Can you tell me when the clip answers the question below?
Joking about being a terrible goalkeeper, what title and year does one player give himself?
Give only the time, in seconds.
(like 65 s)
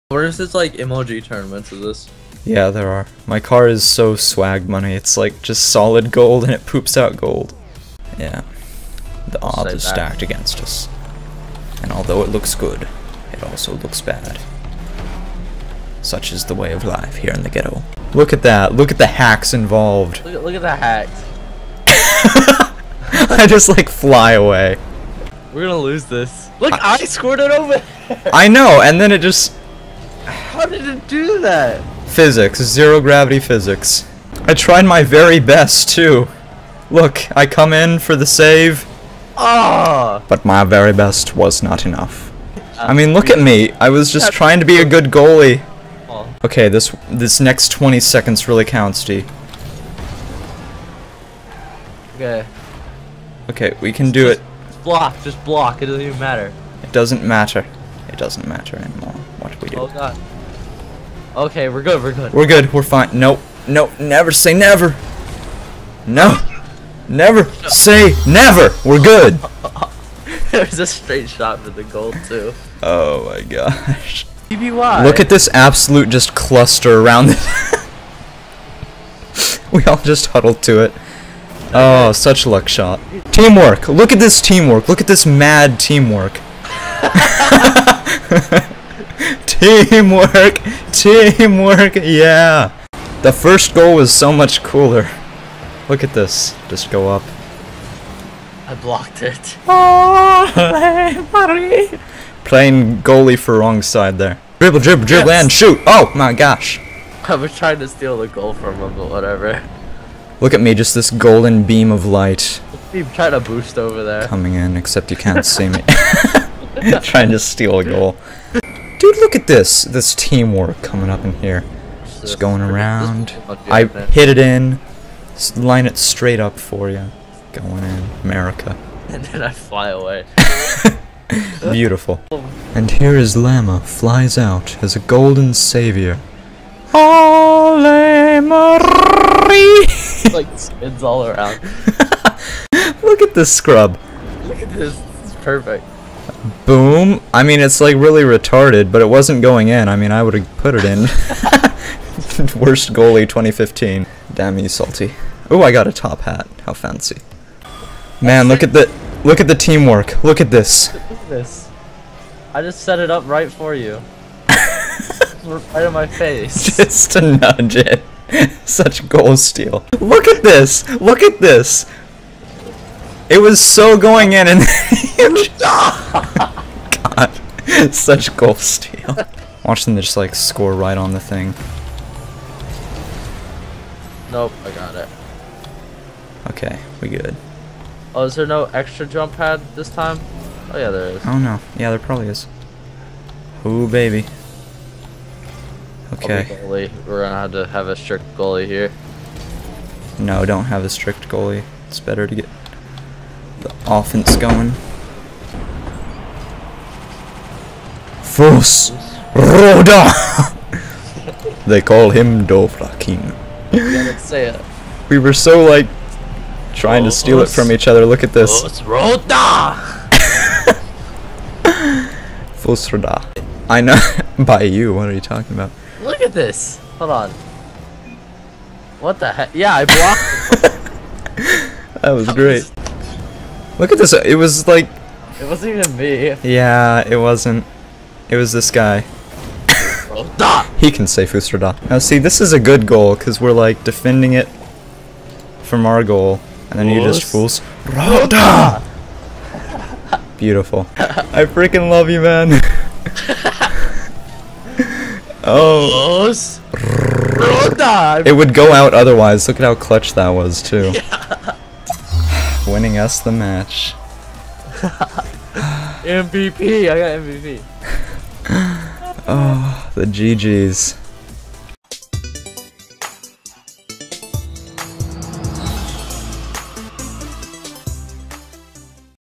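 152 s.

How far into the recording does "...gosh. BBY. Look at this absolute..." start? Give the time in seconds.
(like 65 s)
73 s.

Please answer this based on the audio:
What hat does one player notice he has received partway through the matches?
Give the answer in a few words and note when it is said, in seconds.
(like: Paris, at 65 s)
Top hat, at 155 s.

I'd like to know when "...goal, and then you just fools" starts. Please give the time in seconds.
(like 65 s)
246 s.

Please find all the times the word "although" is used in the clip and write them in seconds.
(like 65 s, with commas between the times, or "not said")
11 s.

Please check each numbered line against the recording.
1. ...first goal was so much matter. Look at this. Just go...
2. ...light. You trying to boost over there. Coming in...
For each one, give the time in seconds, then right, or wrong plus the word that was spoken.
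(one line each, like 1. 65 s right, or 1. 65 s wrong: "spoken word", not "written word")
1. 93 s wrong: "cooler", not "matter"
2. 112 s right.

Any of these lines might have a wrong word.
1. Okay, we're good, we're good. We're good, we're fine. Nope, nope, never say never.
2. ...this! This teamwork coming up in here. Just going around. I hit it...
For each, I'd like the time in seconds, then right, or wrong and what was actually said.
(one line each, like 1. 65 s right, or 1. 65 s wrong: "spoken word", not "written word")
1. 61 s right
2. 119 s right.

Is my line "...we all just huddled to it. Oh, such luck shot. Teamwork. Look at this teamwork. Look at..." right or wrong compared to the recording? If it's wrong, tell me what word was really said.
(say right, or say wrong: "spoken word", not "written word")
right.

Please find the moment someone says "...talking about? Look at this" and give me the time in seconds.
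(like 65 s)
225 s.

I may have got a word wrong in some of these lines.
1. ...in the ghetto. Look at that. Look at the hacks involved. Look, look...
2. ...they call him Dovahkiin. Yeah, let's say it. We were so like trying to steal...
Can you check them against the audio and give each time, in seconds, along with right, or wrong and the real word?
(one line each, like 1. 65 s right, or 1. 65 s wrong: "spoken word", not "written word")
1. 17 s right
2. 211 s right.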